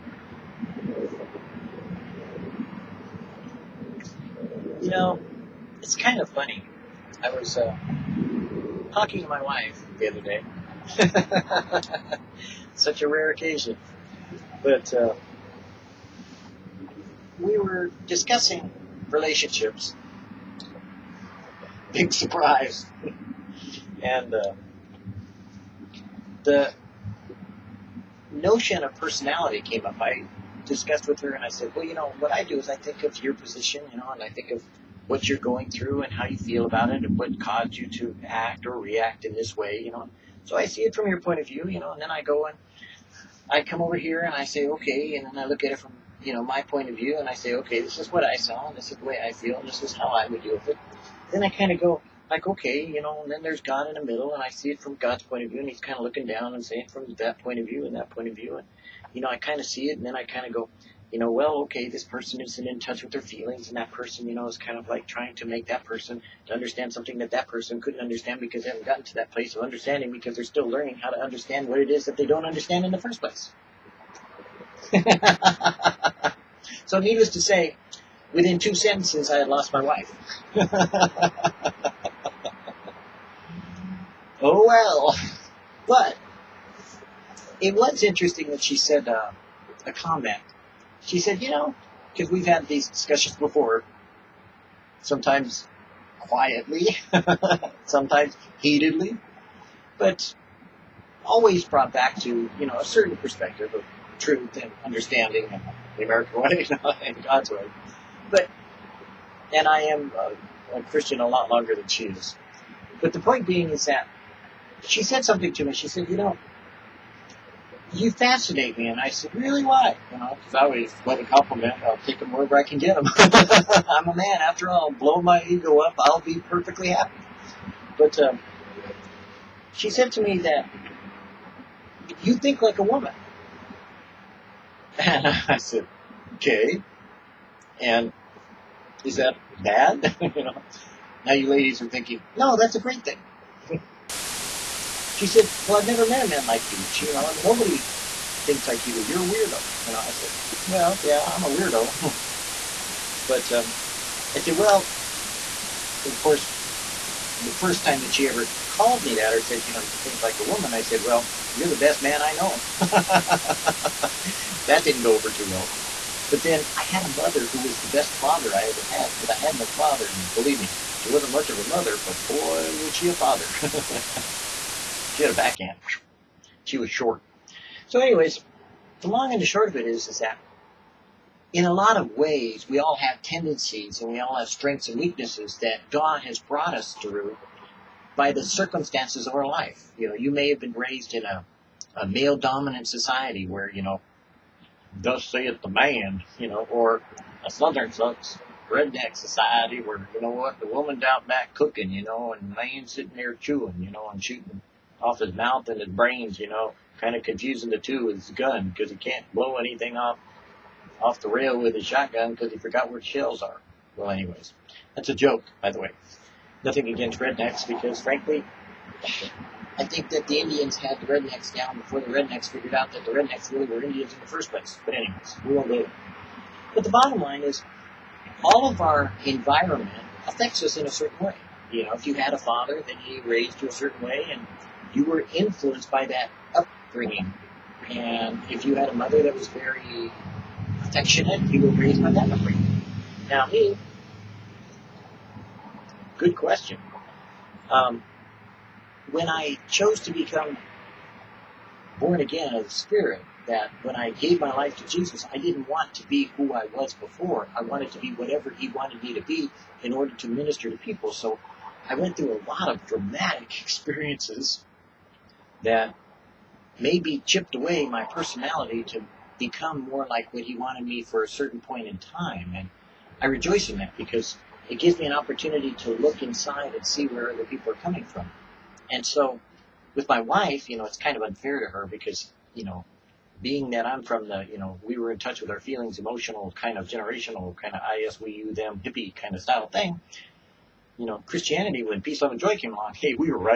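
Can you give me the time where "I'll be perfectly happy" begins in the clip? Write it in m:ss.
2:05.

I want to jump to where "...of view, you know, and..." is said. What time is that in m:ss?
0:41.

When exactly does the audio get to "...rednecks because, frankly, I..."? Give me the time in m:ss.
3:37.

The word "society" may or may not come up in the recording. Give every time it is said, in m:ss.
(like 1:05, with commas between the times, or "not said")
3:12, 3:19.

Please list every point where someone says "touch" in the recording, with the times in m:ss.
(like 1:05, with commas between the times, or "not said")
1:02, 4:45.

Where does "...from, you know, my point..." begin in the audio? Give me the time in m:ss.
0:45.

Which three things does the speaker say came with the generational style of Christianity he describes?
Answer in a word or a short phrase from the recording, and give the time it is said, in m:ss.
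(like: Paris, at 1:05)
peace, love, and joy, at 4:52.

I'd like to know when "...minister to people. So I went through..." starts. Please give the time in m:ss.
4:20.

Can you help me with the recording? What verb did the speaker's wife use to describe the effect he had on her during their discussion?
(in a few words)
fascinate.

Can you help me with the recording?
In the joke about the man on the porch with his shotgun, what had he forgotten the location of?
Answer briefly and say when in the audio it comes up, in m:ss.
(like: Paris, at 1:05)
shells, at 3:33.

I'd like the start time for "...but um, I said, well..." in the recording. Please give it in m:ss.
2:33.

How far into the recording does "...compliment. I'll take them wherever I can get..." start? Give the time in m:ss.
2:01.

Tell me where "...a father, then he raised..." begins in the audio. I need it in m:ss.
3:52.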